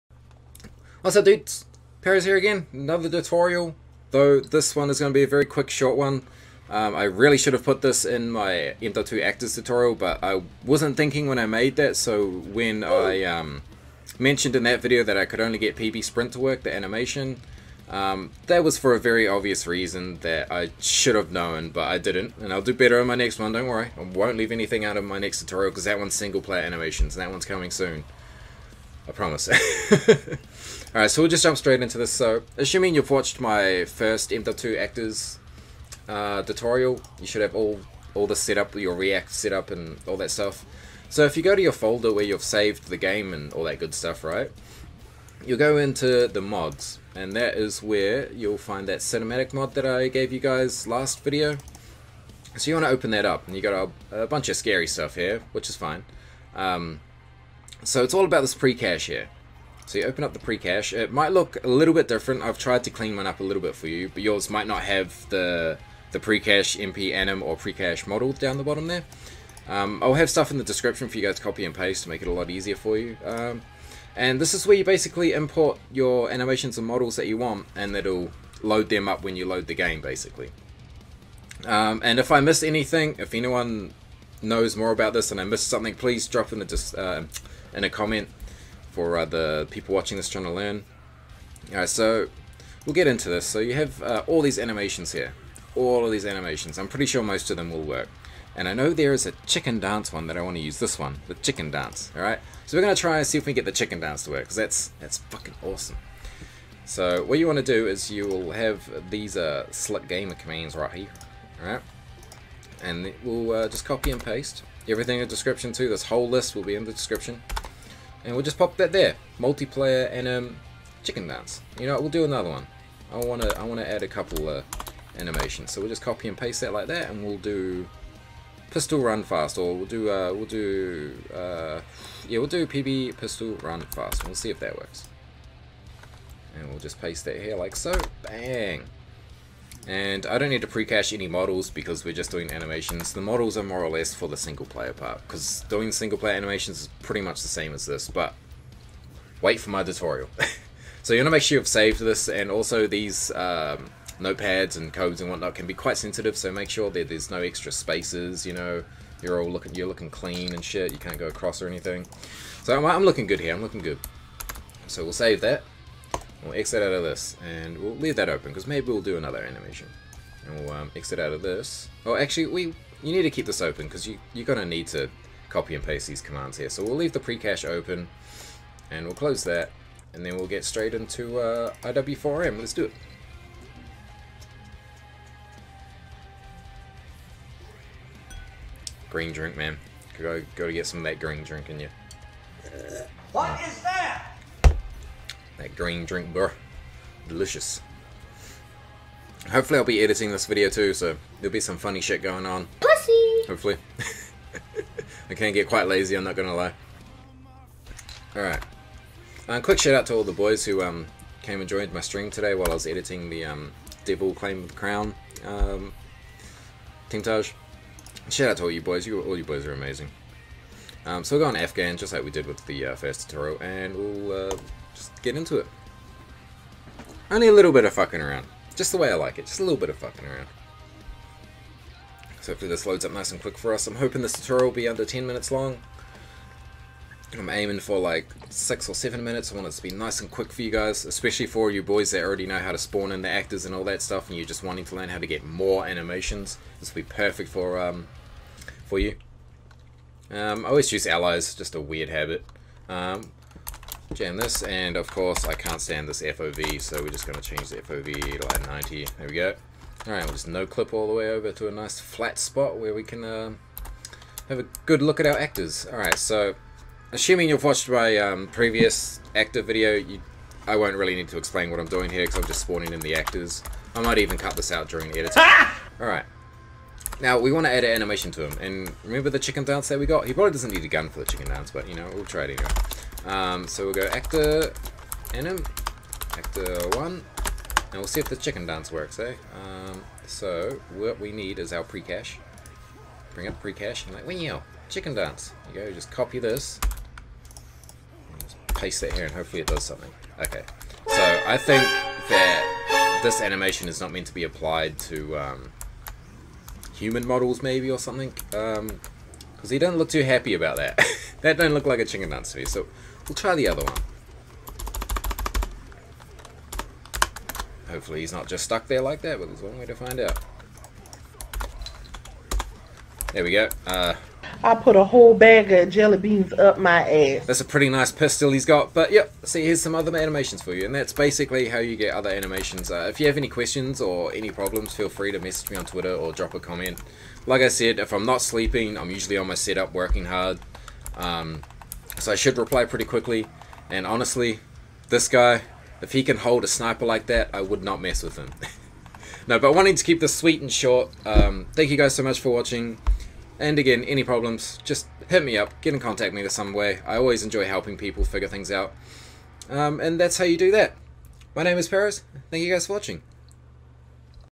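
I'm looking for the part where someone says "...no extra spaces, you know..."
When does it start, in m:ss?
2:37.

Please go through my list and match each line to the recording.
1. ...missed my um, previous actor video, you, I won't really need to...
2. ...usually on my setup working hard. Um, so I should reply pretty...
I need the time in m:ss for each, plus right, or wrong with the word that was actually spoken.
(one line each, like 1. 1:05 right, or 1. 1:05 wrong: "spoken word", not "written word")
1. 4:27 wrong: "watched", not "missed"
2. 5:39 right.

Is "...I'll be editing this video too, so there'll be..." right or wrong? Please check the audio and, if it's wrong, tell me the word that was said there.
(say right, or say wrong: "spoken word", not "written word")
right.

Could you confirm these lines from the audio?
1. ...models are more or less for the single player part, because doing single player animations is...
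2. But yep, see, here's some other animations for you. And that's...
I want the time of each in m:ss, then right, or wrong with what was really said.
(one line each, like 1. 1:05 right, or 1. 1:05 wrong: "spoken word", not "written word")
1. 2:23 right
2. 5:28 right.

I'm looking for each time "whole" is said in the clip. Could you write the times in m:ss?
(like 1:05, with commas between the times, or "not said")
1:56, 5:25.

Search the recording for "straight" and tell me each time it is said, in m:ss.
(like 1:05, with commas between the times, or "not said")
0:31, 3:00.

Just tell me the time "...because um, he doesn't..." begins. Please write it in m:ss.
5:08.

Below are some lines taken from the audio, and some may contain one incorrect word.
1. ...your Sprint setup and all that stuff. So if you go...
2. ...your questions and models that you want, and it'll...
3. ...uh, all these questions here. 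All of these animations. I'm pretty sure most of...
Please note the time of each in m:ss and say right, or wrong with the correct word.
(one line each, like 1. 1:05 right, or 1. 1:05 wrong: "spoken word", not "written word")
1. 0:38 wrong: "React", not "Sprint"
2. 1:15 wrong: "animations", not "questions"
3. 1:34 wrong: "animations", not "questions".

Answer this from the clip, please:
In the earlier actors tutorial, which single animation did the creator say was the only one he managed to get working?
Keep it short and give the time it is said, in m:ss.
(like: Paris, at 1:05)
PB Sprint, at 0:15.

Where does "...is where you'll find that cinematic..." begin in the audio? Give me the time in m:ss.
0:47.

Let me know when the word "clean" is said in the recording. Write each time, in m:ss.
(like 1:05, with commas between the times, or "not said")
1:02, 2:40.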